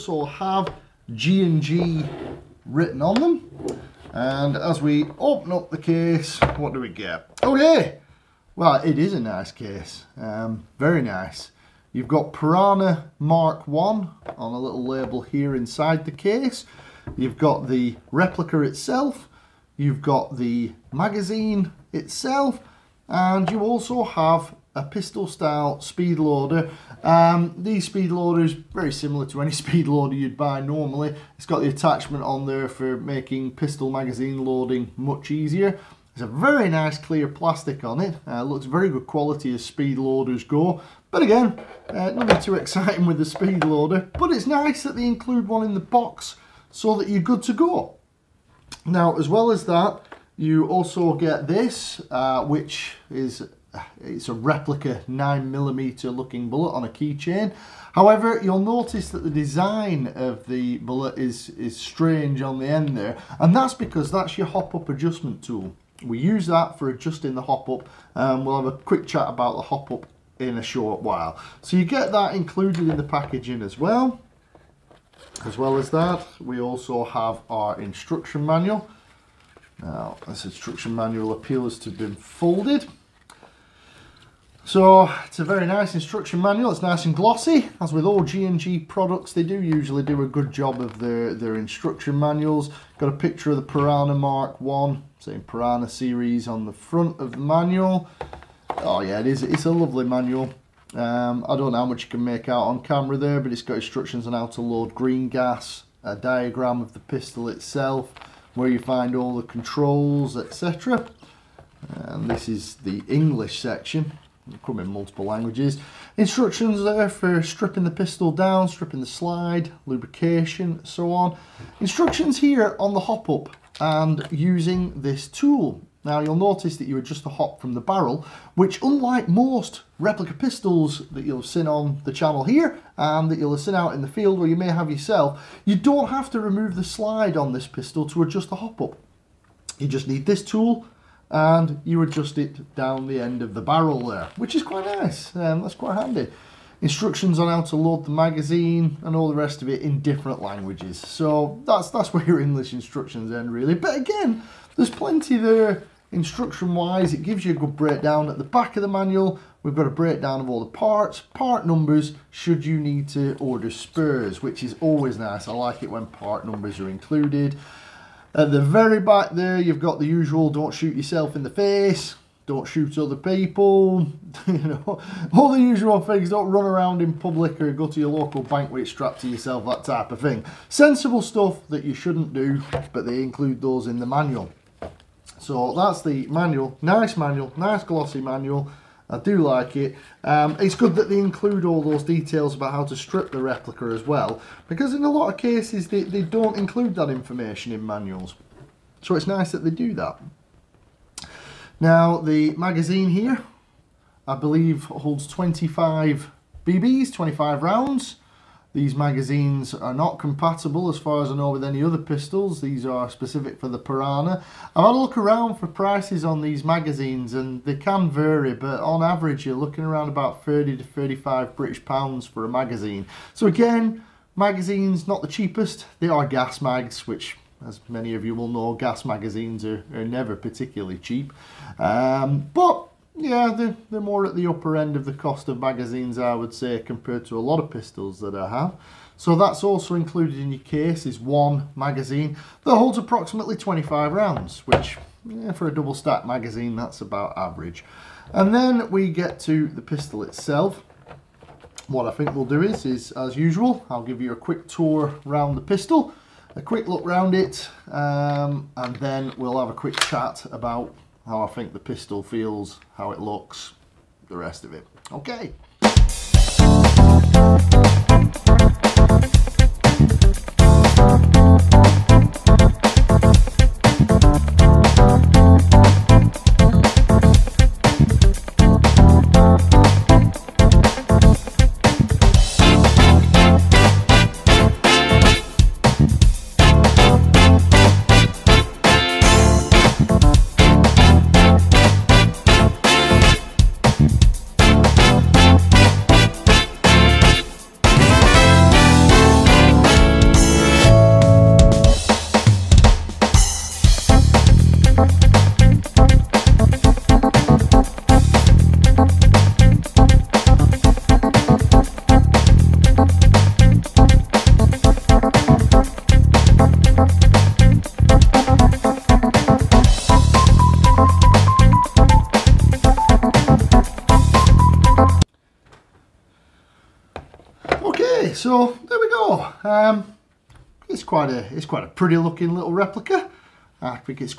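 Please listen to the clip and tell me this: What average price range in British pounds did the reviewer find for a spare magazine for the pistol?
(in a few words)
30 to 35 pounds.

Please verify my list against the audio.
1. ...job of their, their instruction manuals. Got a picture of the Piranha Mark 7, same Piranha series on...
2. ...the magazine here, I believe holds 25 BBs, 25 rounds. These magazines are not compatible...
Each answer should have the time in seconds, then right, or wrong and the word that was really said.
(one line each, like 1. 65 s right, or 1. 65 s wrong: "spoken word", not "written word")
1. 90 s wrong: "1", not "7"
2. 202 s right.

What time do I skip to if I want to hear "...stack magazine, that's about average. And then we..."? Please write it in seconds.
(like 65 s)
245 s.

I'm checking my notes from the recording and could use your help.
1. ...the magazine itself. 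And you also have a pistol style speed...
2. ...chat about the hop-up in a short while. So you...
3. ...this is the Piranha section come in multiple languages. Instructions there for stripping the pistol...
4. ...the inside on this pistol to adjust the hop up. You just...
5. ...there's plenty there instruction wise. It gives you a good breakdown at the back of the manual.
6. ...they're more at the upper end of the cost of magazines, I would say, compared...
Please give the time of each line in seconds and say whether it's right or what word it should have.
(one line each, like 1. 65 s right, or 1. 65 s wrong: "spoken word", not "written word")
1. 20 s right
2. 69 s right
3. 112 s wrong: "English", not "Piranha"
4. 136 s wrong: "slide", not "inside"
5. 154 s right
6. 233 s right.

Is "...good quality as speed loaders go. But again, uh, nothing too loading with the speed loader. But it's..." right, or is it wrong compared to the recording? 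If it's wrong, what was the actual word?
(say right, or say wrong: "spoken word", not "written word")
wrong: "exciting", not "loading".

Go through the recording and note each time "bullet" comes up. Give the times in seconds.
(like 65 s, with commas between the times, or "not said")
56 s, 60 s.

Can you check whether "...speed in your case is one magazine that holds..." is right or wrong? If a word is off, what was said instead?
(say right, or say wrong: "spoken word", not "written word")
wrong: "included", not "speed".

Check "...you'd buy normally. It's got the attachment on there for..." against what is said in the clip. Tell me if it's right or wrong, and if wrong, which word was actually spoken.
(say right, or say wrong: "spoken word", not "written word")
right.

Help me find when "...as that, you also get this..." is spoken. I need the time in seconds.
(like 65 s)
49 s.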